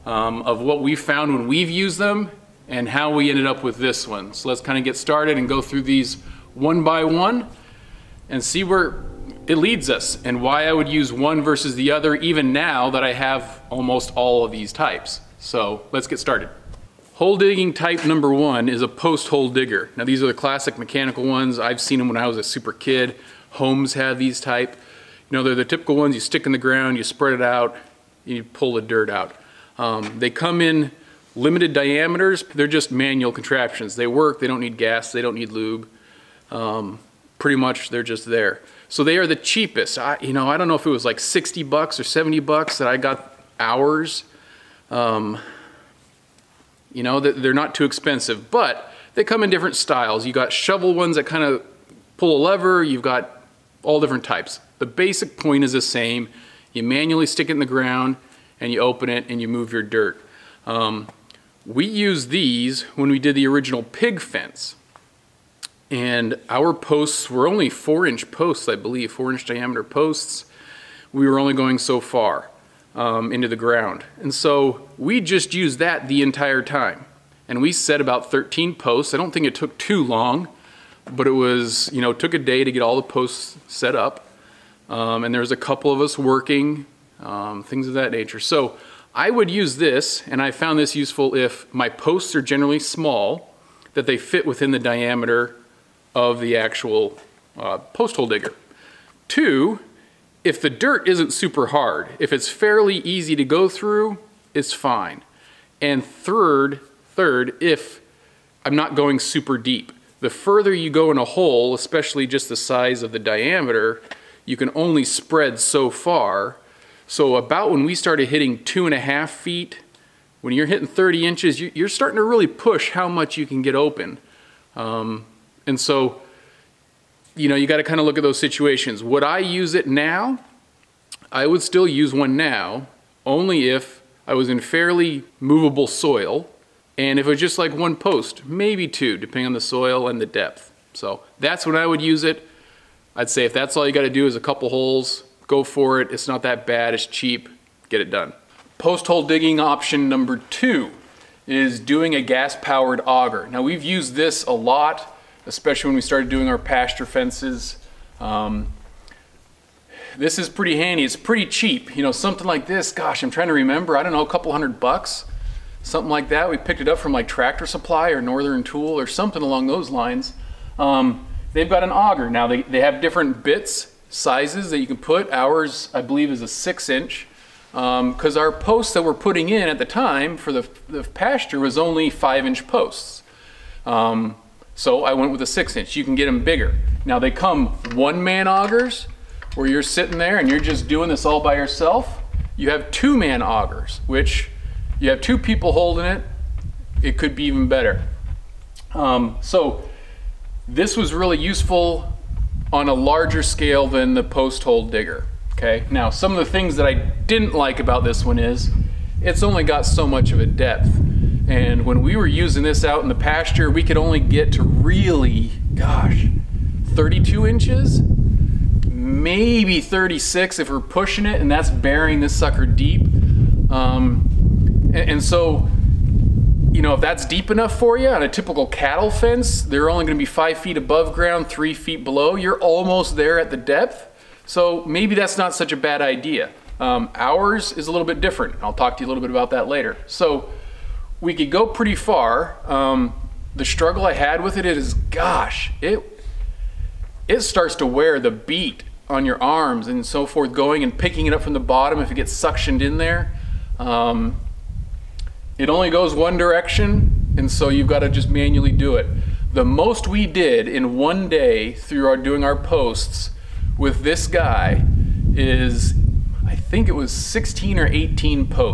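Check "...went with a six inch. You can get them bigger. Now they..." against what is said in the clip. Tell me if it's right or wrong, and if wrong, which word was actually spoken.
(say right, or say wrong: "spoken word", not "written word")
right.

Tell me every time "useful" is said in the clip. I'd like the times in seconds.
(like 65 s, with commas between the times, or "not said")
90 s, 201 s.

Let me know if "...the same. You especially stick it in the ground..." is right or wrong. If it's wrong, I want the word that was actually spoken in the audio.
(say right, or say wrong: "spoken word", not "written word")
wrong: "manually", not "especially".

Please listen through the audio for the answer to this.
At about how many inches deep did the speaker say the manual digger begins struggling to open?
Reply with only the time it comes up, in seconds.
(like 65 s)
120 s.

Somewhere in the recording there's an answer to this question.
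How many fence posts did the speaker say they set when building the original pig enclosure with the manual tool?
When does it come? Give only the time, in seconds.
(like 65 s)
78 s.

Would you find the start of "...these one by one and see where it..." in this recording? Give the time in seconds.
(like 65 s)
5 s.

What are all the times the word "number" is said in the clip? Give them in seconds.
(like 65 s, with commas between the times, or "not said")
18 s, 150 s.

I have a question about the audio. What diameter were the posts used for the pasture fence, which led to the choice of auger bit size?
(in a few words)
5 inch.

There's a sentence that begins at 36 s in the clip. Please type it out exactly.
Um, pretty much they're just there.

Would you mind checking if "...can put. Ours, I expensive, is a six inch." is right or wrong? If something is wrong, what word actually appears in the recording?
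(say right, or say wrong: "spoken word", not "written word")
wrong: "believe", not "expensive".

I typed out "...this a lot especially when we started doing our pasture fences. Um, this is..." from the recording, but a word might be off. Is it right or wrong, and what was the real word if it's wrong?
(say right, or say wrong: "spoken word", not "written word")
right.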